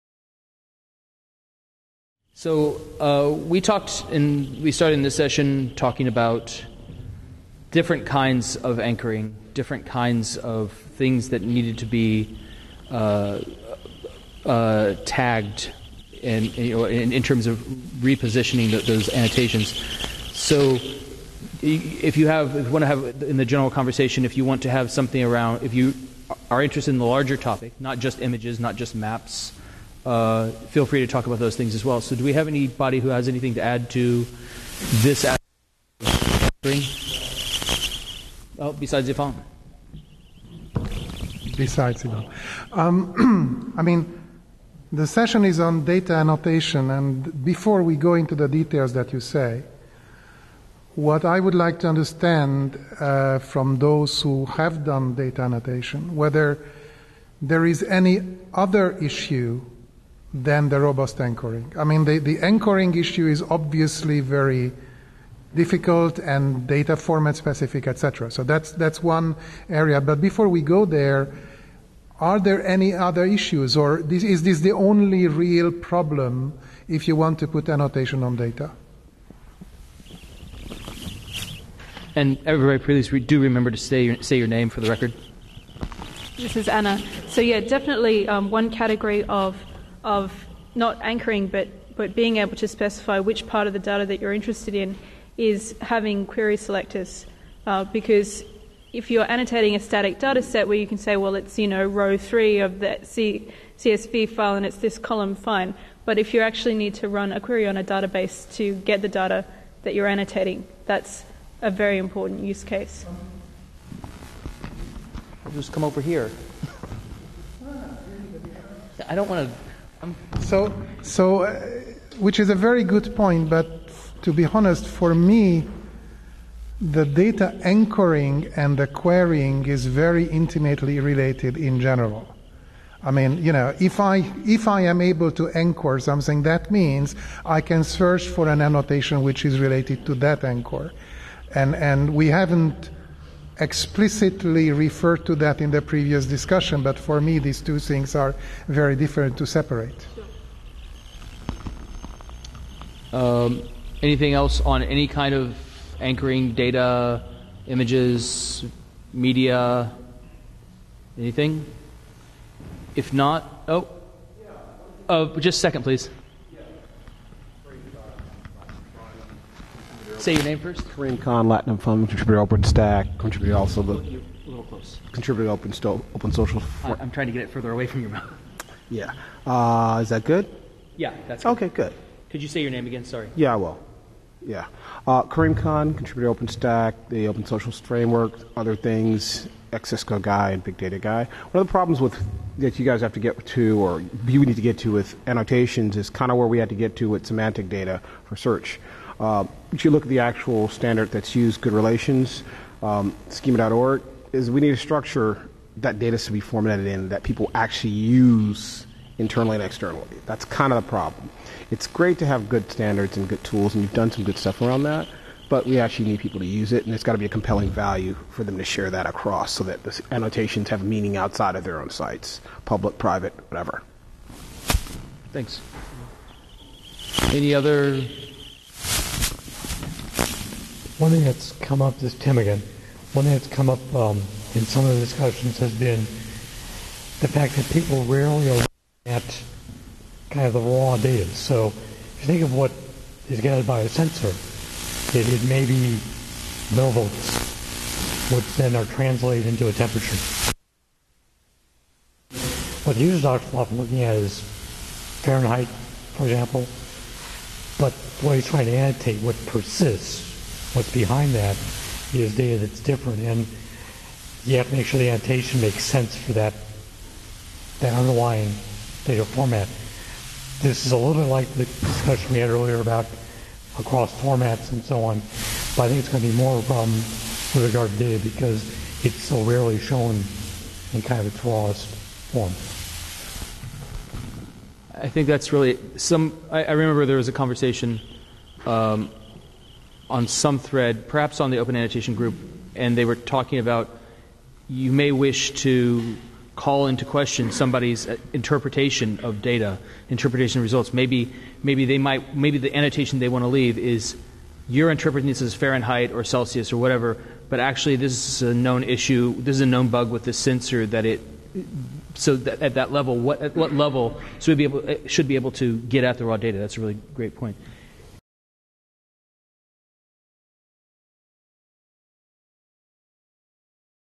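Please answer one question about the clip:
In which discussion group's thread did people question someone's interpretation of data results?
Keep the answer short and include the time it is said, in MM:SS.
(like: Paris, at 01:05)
Open Annotation Group, at 04:51.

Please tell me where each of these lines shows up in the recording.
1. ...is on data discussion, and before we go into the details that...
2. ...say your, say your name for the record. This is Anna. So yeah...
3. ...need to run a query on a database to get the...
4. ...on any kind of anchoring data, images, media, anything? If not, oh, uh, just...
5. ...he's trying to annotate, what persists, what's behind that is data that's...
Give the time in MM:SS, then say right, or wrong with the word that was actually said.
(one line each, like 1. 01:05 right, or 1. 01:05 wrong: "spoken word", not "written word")
1. 00:45 wrong: "annotation", not "discussion"
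2. 01:23 right
3. 01:46 right
4. 02:34 right
5. 04:18 right.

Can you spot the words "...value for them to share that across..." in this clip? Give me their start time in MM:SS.
03:37.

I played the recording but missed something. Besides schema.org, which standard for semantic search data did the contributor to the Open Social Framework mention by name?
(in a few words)
Good Relations.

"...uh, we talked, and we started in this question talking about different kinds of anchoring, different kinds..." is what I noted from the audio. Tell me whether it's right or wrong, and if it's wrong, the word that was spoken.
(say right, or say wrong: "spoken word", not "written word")
wrong: "session", not "question".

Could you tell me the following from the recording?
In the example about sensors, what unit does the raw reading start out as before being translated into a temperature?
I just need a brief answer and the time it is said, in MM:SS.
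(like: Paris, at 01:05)
millivolts, at 04:06.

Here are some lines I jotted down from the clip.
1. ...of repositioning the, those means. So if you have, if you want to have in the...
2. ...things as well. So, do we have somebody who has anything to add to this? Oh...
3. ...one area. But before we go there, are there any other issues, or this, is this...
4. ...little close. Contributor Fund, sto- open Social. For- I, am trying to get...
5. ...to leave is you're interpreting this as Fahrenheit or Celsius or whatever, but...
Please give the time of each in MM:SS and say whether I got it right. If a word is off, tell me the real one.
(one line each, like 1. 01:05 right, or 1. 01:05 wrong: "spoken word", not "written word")
1. 00:17 wrong: "annotations", not "means"
2. 00:31 wrong: "anybody", not "somebody"
3. 01:09 right
4. 02:54 wrong: "Open", not "Fund"
5. 05:03 right.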